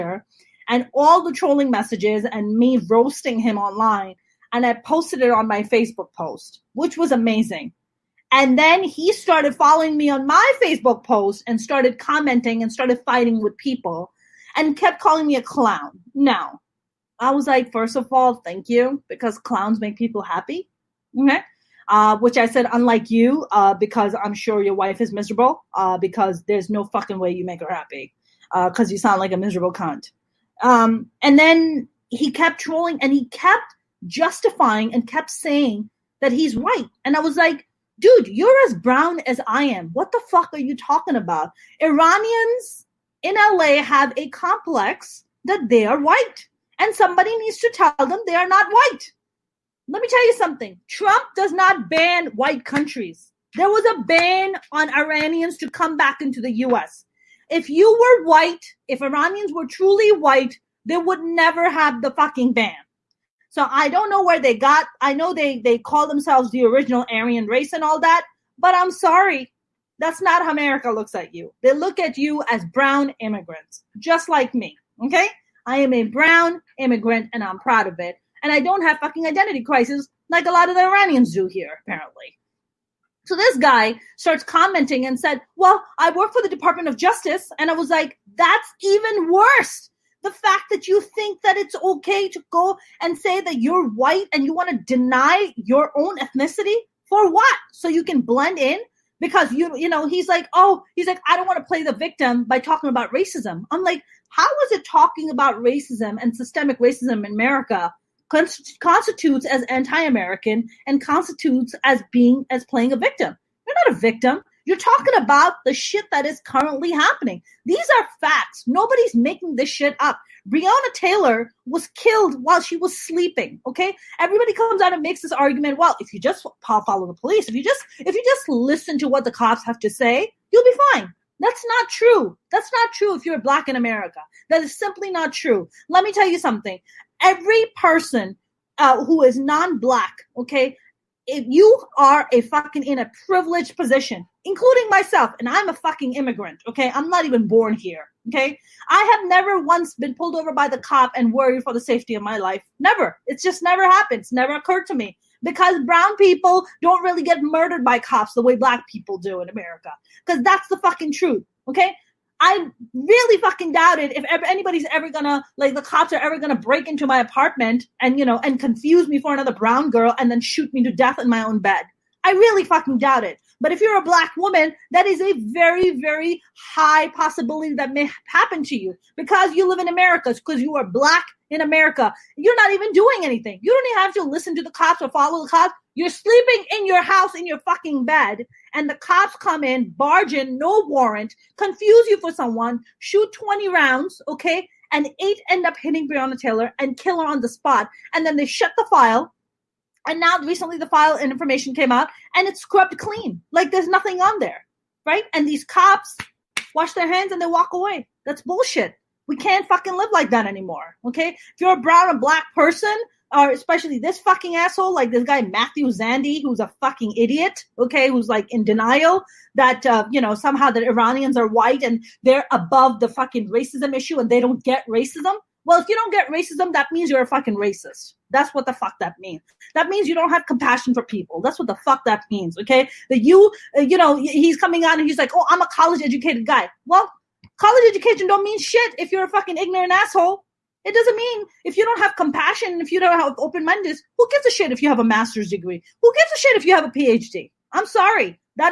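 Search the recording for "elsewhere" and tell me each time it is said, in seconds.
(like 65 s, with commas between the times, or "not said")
not said.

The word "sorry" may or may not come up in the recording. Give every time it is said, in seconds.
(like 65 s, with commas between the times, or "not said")
68 s, 247 s.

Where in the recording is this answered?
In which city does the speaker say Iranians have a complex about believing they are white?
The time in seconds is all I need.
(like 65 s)
43 s.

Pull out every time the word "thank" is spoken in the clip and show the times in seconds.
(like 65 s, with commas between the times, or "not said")
18 s.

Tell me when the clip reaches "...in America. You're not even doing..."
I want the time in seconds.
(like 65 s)
181 s.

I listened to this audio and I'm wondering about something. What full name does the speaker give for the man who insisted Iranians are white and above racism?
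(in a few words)
Matthew Zandi.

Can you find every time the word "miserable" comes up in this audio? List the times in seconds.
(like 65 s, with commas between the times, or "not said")
25 s, 29 s.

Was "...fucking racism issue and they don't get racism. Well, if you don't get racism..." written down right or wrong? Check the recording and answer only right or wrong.
right.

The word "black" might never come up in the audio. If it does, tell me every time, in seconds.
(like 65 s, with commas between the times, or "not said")
133 s, 139 s, 158 s, 174 s, 180 s, 212 s.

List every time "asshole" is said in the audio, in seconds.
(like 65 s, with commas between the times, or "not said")
214 s, 239 s.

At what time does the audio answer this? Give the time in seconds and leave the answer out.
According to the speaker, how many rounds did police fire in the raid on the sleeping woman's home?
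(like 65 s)
193 s.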